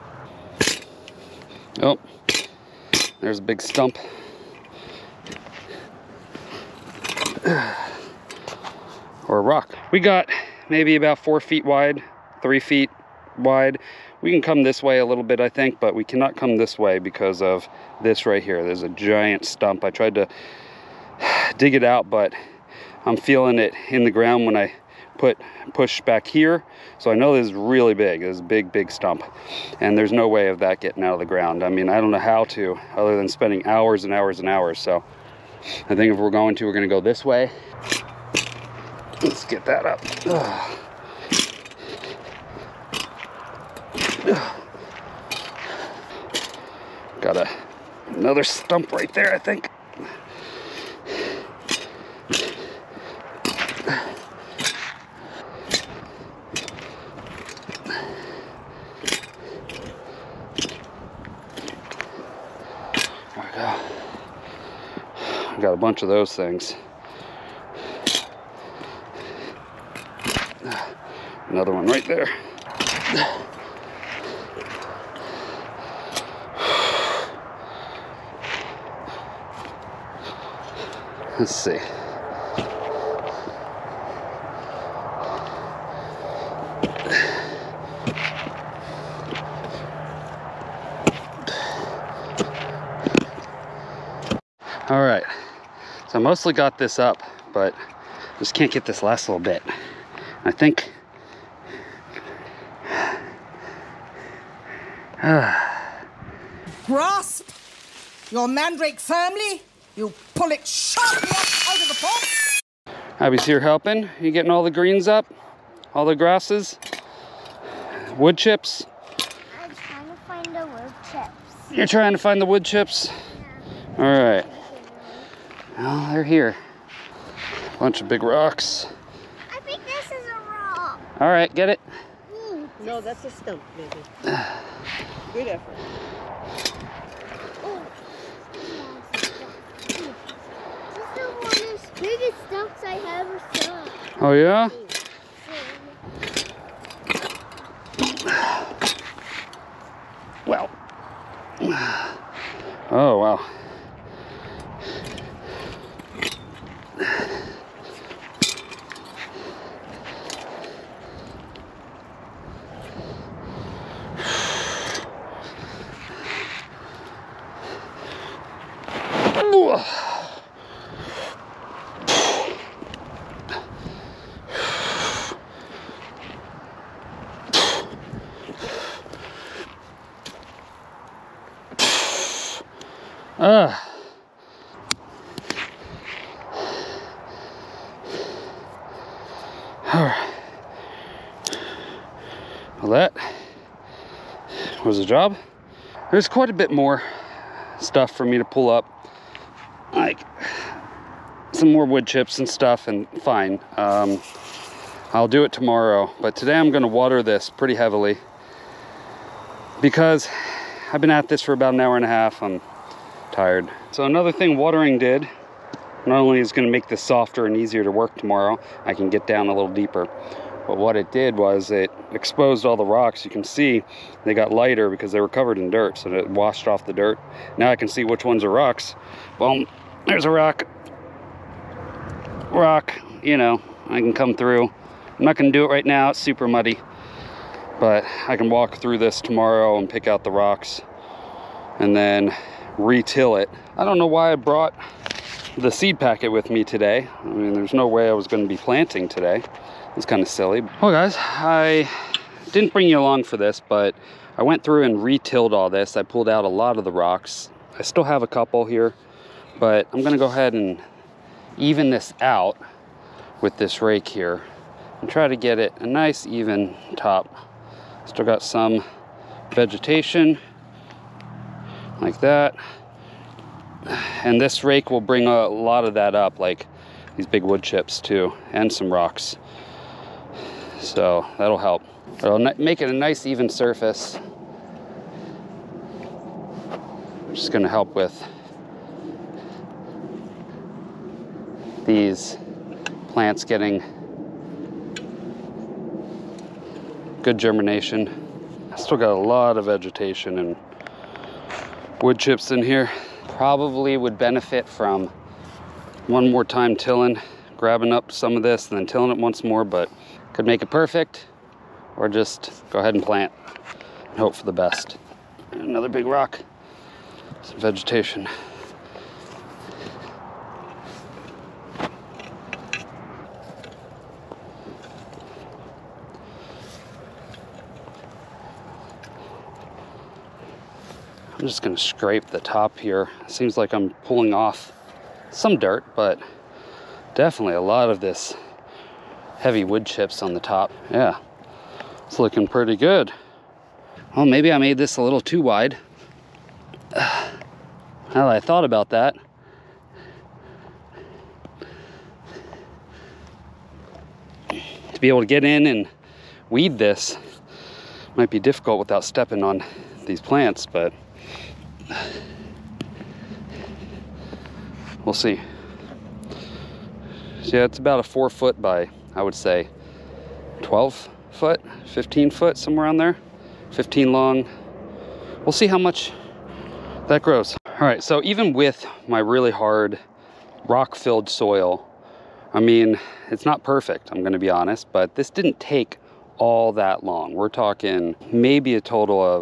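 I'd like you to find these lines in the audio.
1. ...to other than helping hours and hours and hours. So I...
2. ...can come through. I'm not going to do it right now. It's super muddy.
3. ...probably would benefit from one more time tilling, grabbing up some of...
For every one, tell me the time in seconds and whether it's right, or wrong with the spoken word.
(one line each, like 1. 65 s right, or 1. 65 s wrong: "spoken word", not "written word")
1. 32 s wrong: "spending", not "helping"
2. 233 s right
3. 303 s right.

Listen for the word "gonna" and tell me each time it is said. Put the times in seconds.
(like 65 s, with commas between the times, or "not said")
206 s, 287 s, 331 s, 384 s.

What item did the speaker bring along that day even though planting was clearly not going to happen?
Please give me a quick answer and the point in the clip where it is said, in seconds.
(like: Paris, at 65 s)
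Seed packet, at 245 s.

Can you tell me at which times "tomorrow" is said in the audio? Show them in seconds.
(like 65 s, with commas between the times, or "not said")
205 s, 218 s, 239 s.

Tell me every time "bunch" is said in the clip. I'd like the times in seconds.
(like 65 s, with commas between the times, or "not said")
65 s, 127 s.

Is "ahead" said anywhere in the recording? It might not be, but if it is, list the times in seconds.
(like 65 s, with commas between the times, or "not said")
260 s, 312 s.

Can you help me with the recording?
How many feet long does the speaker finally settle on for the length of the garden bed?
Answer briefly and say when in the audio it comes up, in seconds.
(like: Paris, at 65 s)
15, at 373 s.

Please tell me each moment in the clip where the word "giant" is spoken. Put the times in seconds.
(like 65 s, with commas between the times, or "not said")
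18 s.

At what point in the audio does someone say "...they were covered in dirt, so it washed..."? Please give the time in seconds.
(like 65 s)
225 s.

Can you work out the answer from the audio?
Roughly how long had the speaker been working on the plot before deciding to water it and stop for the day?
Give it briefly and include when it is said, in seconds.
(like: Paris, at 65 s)
An hour and a half, at 211 s.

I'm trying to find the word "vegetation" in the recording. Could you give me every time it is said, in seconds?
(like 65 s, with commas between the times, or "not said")
269 s, 299 s, 317 s.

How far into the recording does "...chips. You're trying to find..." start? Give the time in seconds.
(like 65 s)
121 s.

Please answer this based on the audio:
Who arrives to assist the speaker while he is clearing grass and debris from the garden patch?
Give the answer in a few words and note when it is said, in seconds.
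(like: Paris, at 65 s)
Abby, at 113 s.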